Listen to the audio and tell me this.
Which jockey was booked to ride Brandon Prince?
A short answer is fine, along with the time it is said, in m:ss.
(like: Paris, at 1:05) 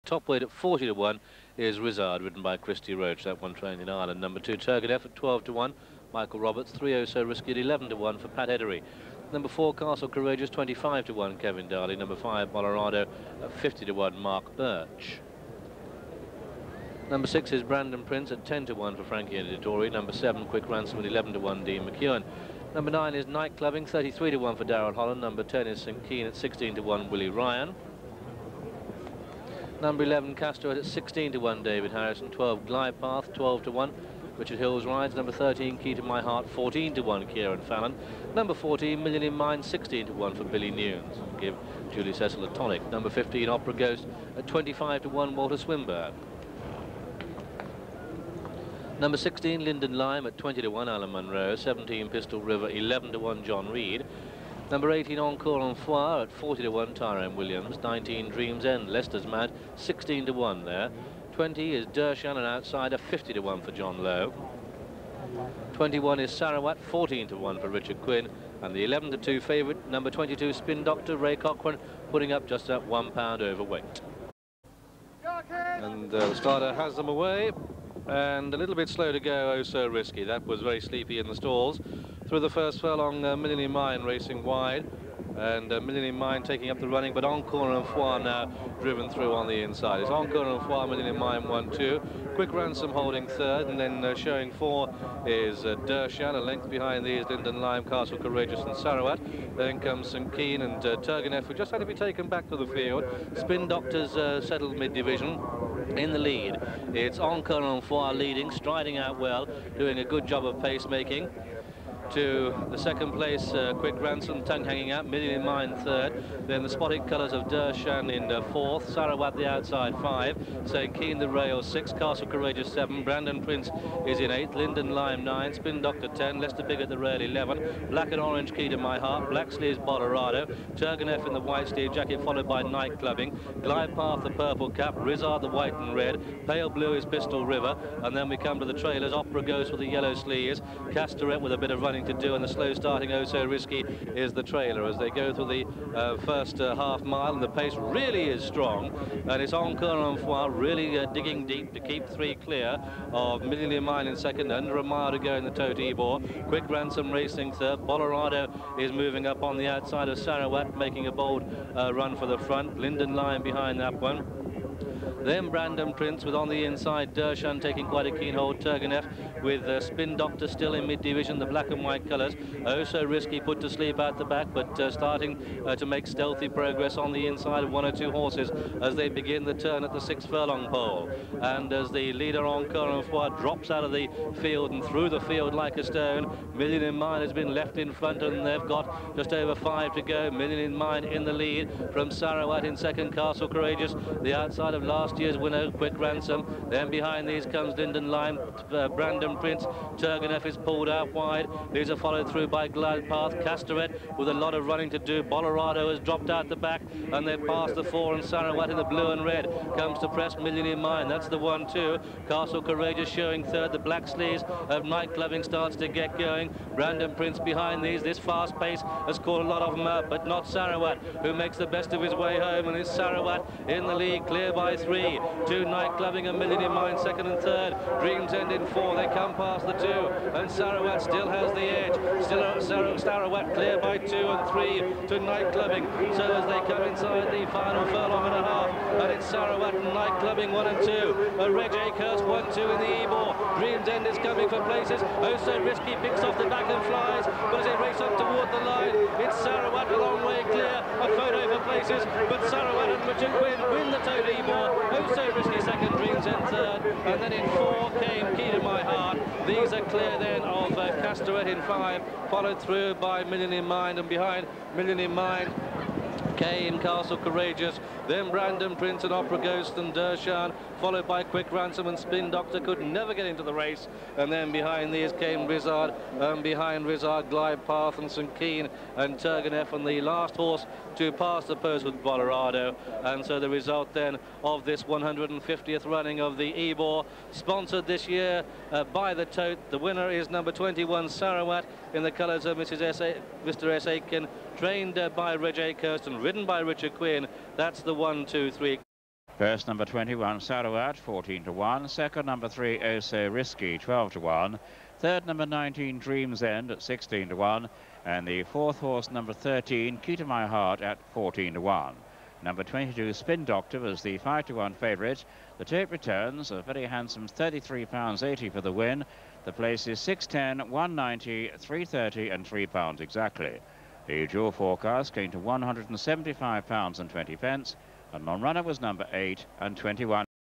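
Frankie Dettori, at 0:19.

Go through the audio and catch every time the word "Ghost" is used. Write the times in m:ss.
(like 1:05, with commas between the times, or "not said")
0:43, 2:19, 4:29.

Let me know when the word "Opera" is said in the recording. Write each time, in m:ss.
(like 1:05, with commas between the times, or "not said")
0:43, 2:19, 4:29.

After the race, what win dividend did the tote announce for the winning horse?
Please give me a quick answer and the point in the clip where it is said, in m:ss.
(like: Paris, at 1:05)
£33.80, at 5:17.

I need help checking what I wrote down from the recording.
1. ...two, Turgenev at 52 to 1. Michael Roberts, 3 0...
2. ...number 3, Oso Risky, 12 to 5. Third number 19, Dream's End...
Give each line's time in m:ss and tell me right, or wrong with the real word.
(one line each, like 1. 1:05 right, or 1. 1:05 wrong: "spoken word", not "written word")
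1. 0:04 wrong: "12", not "52"
2. 5:02 wrong: "1", not "5".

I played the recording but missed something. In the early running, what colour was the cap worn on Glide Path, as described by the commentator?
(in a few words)
Purple.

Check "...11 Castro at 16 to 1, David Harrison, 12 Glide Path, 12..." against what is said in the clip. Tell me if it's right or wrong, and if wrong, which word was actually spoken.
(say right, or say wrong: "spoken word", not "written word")
right.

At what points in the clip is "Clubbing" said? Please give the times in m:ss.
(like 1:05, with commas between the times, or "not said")
0:23, 2:12, 3:35, 3:45, 3:55, 4:00.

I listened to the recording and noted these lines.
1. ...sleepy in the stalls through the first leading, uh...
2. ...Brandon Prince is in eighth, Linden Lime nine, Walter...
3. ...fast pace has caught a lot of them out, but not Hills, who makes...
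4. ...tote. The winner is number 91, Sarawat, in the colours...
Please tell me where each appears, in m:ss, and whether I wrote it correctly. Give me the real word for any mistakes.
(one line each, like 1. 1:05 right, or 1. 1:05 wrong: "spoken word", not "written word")
1. 1:20 wrong: "furlong", not "leading"
2. 2:03 wrong: "Spin", not "Walter"
3. 3:38 wrong: "Sarawat", not "Hills"
4. 4:49 wrong: "21", not "91".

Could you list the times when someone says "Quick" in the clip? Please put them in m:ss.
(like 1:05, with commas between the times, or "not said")
0:20, 1:32, 1:53, 2:36, 3:15, 4:31.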